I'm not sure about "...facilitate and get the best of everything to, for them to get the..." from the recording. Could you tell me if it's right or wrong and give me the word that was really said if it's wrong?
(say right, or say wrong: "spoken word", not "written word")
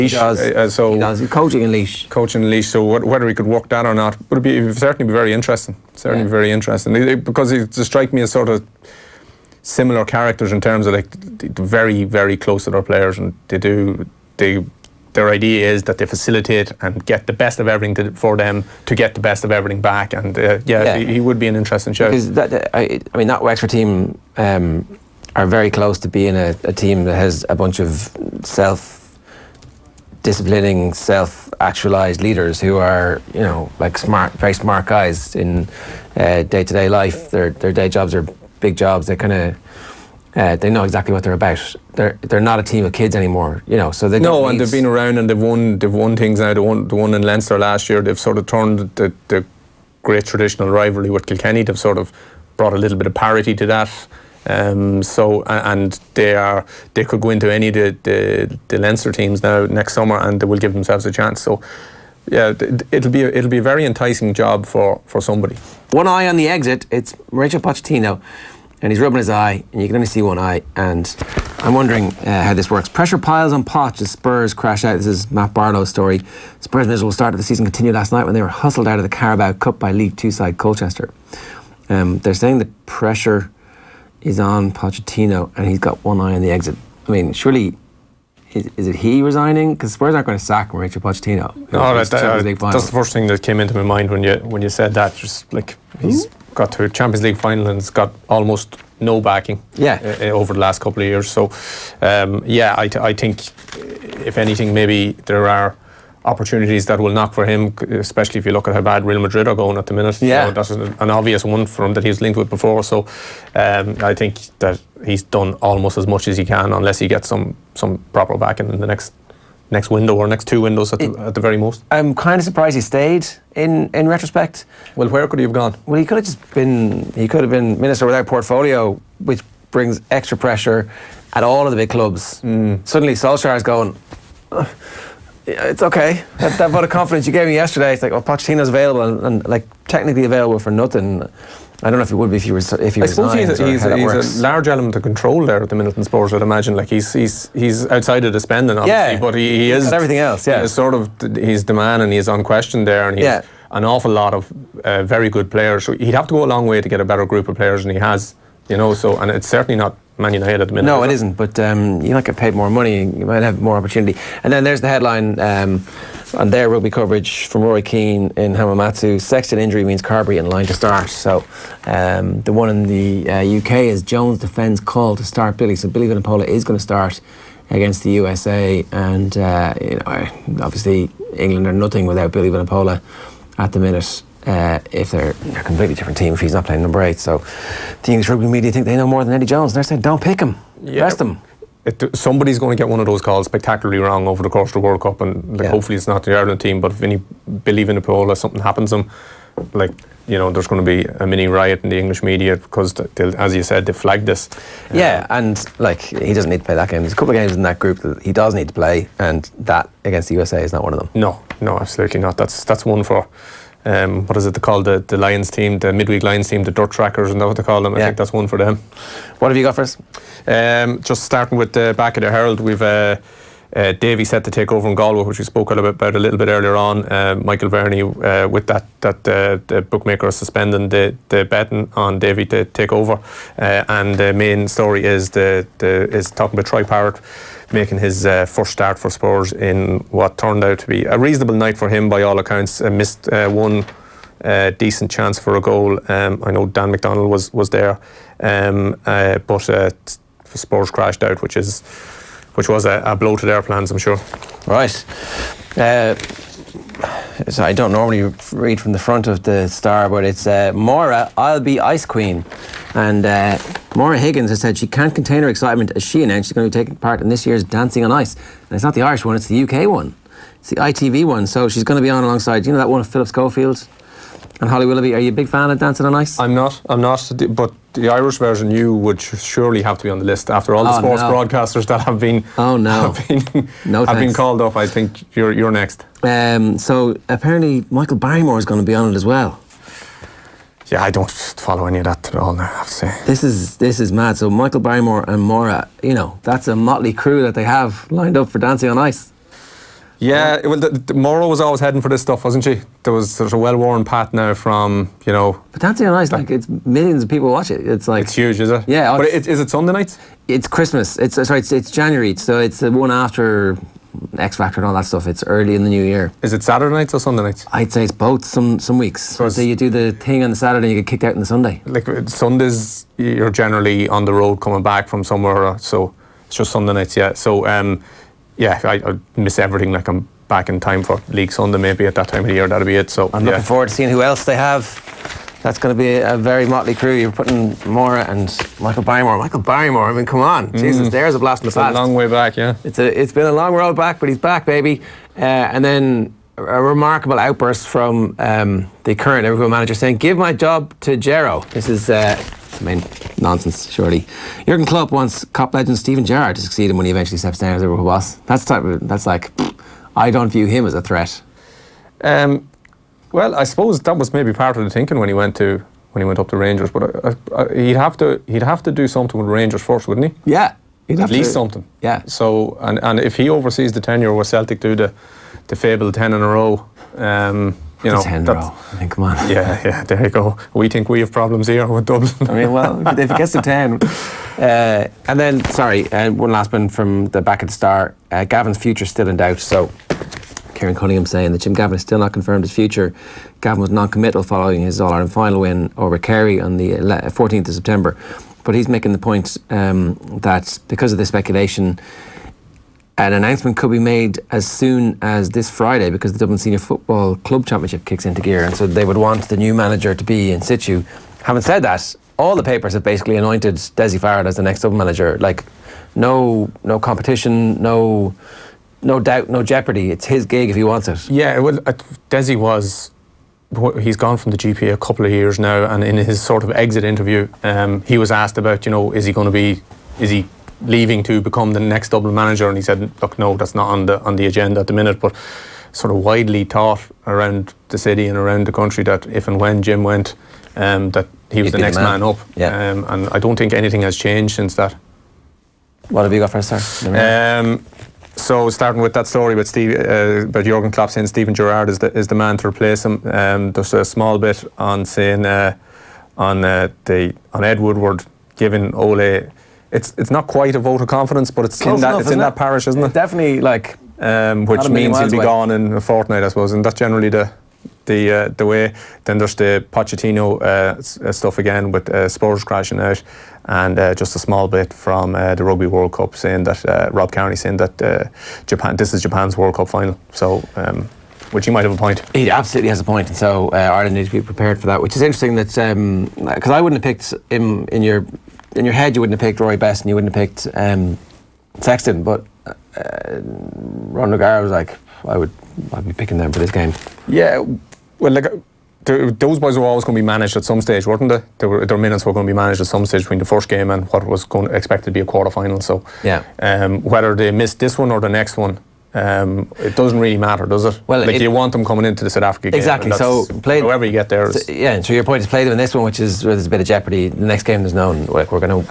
right.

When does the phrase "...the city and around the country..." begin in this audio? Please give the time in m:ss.
7:17.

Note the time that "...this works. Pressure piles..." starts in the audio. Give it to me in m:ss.
1:12.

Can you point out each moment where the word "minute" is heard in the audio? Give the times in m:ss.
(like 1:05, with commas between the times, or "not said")
1:49, 2:40, 3:03, 7:14, 8:21.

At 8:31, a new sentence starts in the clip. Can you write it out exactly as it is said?
Well, like it, you want them coming into the South Africa game.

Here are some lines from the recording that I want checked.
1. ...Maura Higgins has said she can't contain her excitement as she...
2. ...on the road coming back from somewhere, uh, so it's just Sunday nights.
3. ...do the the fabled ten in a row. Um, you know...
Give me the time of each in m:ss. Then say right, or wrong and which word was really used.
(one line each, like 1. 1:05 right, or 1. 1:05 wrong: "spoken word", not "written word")
1. 4:23 right
2. 5:24 right
3. 6:14 right.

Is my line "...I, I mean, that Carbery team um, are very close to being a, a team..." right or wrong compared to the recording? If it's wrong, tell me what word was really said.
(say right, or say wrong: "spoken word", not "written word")
wrong: "Wexford", not "Carbery".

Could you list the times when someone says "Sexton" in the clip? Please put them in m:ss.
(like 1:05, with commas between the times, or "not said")
2:49, 8:11.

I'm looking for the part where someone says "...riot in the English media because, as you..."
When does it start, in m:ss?
3:21.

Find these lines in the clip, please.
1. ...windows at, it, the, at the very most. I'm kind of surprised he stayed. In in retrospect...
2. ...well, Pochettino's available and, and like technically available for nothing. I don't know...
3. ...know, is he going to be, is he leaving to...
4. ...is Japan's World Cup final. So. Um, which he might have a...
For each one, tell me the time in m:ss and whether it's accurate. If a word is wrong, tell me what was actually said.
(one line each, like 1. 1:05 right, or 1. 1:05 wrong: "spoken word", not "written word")
1. 2:00 right
2. 2:18 right
3. 7:08 right
4. 7:59 right.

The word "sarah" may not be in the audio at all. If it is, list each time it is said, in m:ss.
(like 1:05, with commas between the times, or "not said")
not said.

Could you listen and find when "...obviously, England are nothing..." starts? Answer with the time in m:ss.
3:00.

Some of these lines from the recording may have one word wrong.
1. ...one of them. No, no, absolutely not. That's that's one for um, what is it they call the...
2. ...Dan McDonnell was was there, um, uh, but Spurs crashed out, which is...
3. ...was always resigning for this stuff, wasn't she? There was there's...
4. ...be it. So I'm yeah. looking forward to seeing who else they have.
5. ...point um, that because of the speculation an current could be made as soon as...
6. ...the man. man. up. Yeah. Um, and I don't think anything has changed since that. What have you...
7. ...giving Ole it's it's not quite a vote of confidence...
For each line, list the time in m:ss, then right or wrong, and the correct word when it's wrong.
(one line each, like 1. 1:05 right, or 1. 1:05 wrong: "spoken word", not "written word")
1. 3:30 right
2. 4:06 right
3. 5:01 wrong: "heading", not "resigning"
4. 5:32 right
5. 6:39 wrong: "announcement", not "current"
6. 7:21 right
7. 7:38 right.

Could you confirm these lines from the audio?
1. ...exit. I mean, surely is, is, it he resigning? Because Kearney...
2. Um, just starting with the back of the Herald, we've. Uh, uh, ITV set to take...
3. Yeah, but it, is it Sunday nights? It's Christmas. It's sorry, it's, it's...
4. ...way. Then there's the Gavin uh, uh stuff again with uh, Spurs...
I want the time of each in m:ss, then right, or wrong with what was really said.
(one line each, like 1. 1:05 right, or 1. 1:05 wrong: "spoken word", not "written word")
1. 1:26 wrong: "Spurs", not "Kearney"
2. 3:40 wrong: "Davy", not "ITV"
3. 5:08 right
4. 7:48 wrong: "Pochettino", not "Gavin".